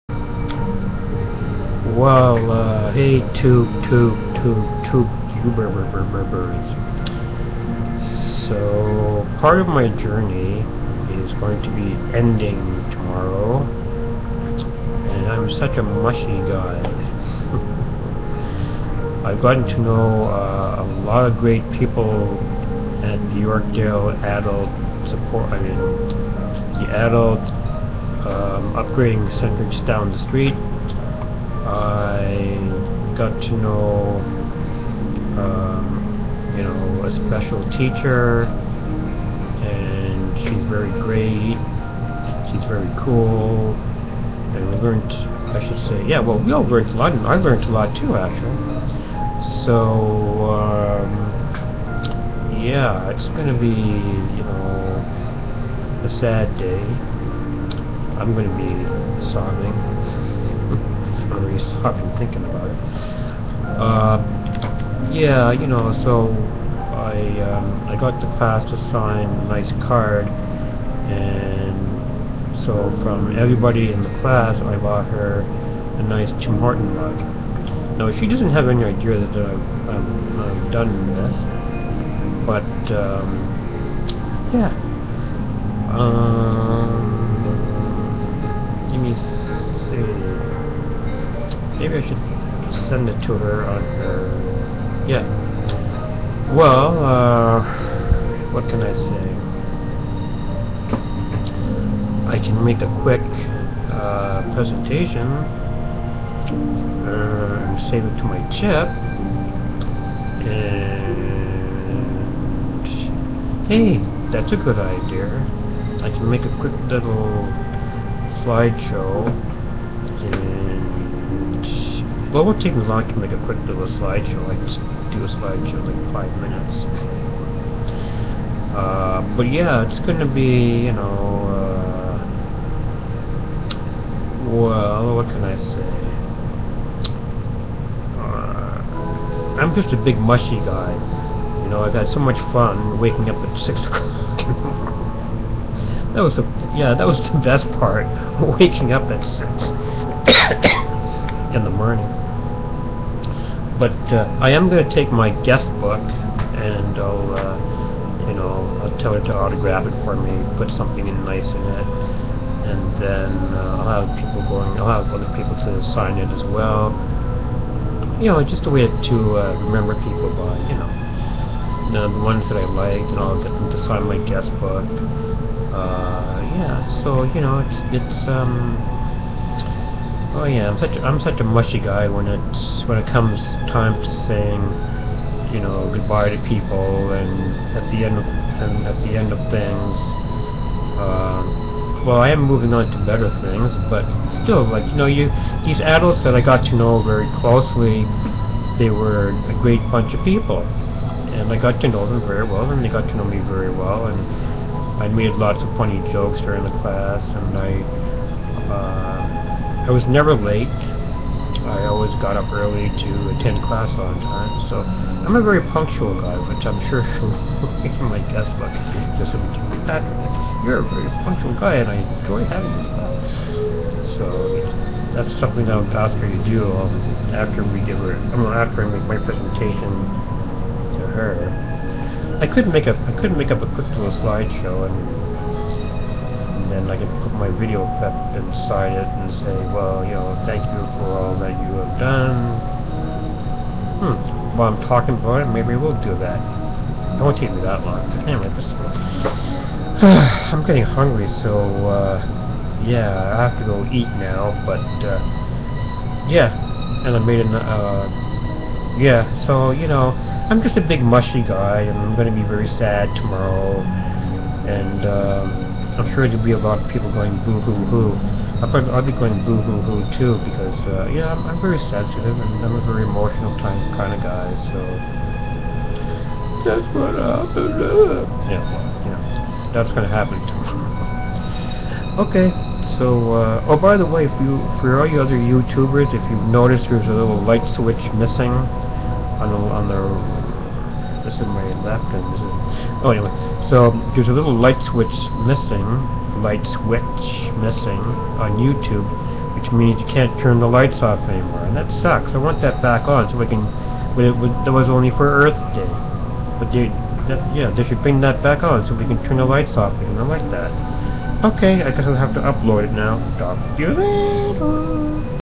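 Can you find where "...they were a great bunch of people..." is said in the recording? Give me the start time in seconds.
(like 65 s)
198 s.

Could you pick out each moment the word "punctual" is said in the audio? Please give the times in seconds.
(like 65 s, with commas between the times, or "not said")
215 s, 221 s.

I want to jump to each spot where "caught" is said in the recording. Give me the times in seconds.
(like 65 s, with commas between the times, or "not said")
61 s.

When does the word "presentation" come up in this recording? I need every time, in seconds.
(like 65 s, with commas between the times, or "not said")
104 s, 229 s.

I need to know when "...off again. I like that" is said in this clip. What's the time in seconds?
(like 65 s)
309 s.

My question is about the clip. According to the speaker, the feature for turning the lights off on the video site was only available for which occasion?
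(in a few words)
Earth Day.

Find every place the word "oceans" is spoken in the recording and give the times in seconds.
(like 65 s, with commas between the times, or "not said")
not said.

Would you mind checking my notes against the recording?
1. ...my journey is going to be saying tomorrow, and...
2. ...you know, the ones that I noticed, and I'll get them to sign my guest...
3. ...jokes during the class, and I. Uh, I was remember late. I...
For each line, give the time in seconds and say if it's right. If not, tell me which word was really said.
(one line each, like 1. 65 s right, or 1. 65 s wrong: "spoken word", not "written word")
1. 9 s wrong: "ending", not "saying"
2. 170 s wrong: "liked", not "noticed"
3. 206 s wrong: "never", not "remember".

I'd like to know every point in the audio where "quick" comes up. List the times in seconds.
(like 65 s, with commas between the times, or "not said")
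103 s, 116 s, 123 s, 233 s.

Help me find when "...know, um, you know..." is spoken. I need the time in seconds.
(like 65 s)
33 s.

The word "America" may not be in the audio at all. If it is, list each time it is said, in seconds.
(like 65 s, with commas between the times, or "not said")
not said.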